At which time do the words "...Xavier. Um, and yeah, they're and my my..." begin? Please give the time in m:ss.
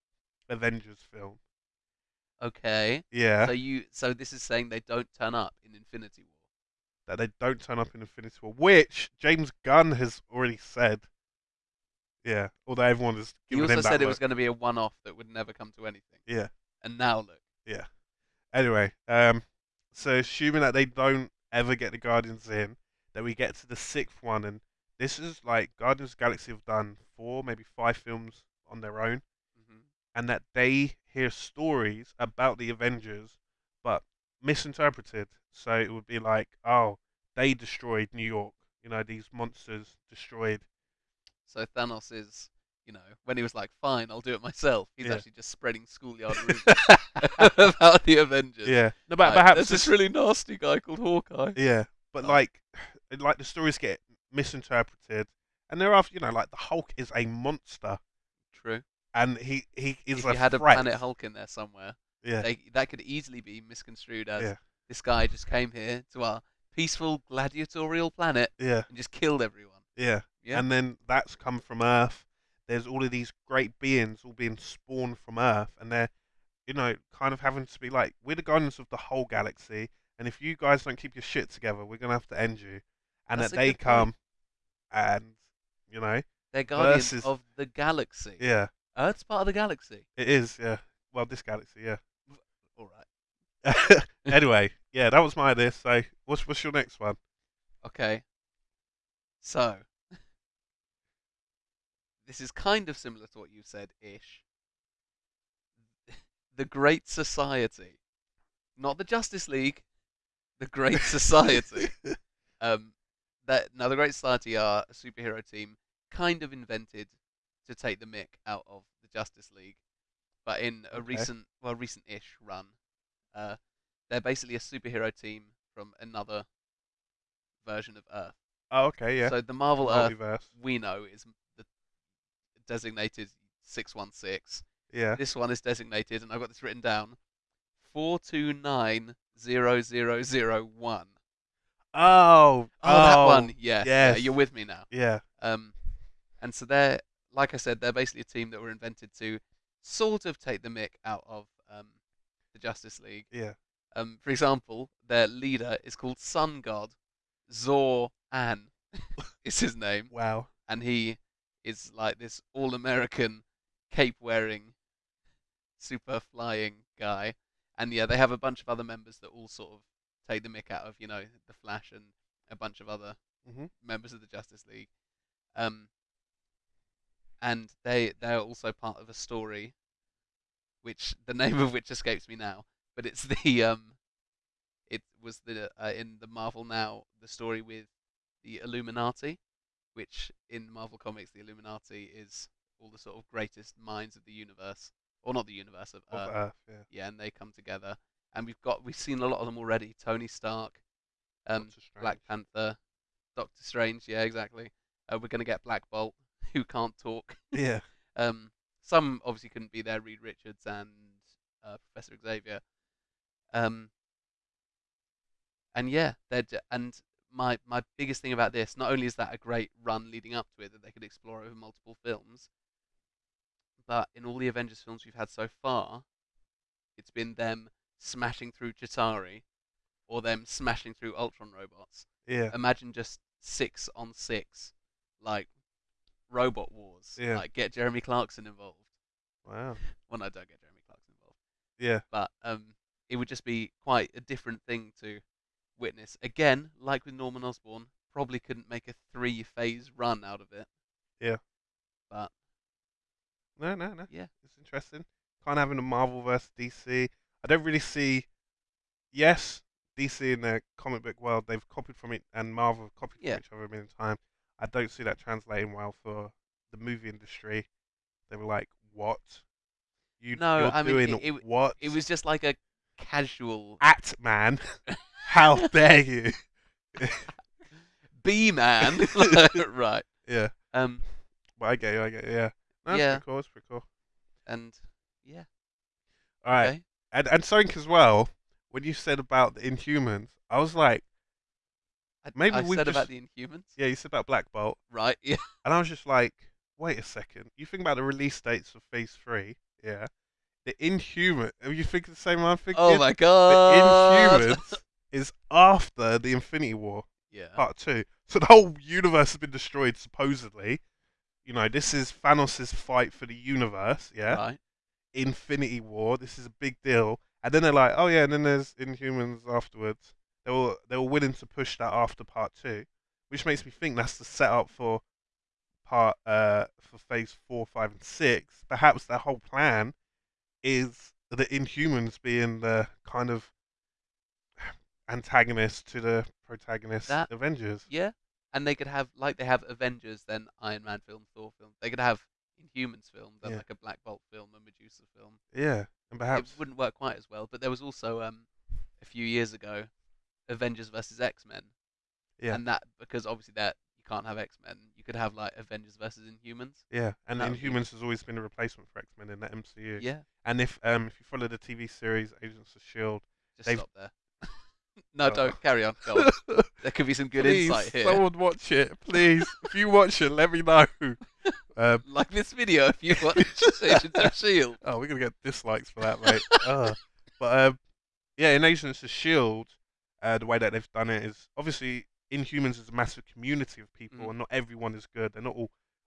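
3:32.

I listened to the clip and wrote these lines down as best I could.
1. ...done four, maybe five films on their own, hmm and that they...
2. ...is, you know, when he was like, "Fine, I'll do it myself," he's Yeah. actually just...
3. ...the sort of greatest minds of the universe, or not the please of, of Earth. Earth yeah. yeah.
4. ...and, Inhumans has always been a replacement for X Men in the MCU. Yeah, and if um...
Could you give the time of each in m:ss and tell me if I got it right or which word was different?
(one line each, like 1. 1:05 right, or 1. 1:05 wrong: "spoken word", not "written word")
1. 0:26 right
2. 0:42 right
3. 3:12 wrong: "universe", not "please"
4. 5:57 right.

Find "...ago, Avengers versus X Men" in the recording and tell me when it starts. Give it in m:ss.
5:49.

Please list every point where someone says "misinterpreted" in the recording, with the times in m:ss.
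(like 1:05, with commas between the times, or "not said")
0:34, 0:54.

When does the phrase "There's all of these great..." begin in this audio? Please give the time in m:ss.
1:12.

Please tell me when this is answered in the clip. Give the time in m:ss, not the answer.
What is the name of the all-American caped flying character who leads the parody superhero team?
2:36.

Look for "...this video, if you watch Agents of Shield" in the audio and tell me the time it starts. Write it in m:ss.
6:12.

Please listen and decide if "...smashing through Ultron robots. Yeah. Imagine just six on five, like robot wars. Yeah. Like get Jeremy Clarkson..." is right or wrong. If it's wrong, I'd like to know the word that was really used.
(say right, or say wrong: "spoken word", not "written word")
wrong: "six", not "five".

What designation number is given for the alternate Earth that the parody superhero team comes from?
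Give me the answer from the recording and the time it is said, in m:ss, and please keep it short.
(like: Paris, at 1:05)
4290001, at 2:17.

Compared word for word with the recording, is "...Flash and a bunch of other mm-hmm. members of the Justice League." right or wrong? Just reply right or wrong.
right.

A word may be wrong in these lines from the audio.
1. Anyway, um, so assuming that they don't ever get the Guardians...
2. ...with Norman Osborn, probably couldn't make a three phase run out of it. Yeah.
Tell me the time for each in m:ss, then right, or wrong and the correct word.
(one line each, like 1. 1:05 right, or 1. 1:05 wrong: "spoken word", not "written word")
1. 0:18 right
2. 4:07 right.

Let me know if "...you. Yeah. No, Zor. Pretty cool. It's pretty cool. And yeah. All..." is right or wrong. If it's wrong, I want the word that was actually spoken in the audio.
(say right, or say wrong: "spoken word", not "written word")
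wrong: "Yeah", not "Zor".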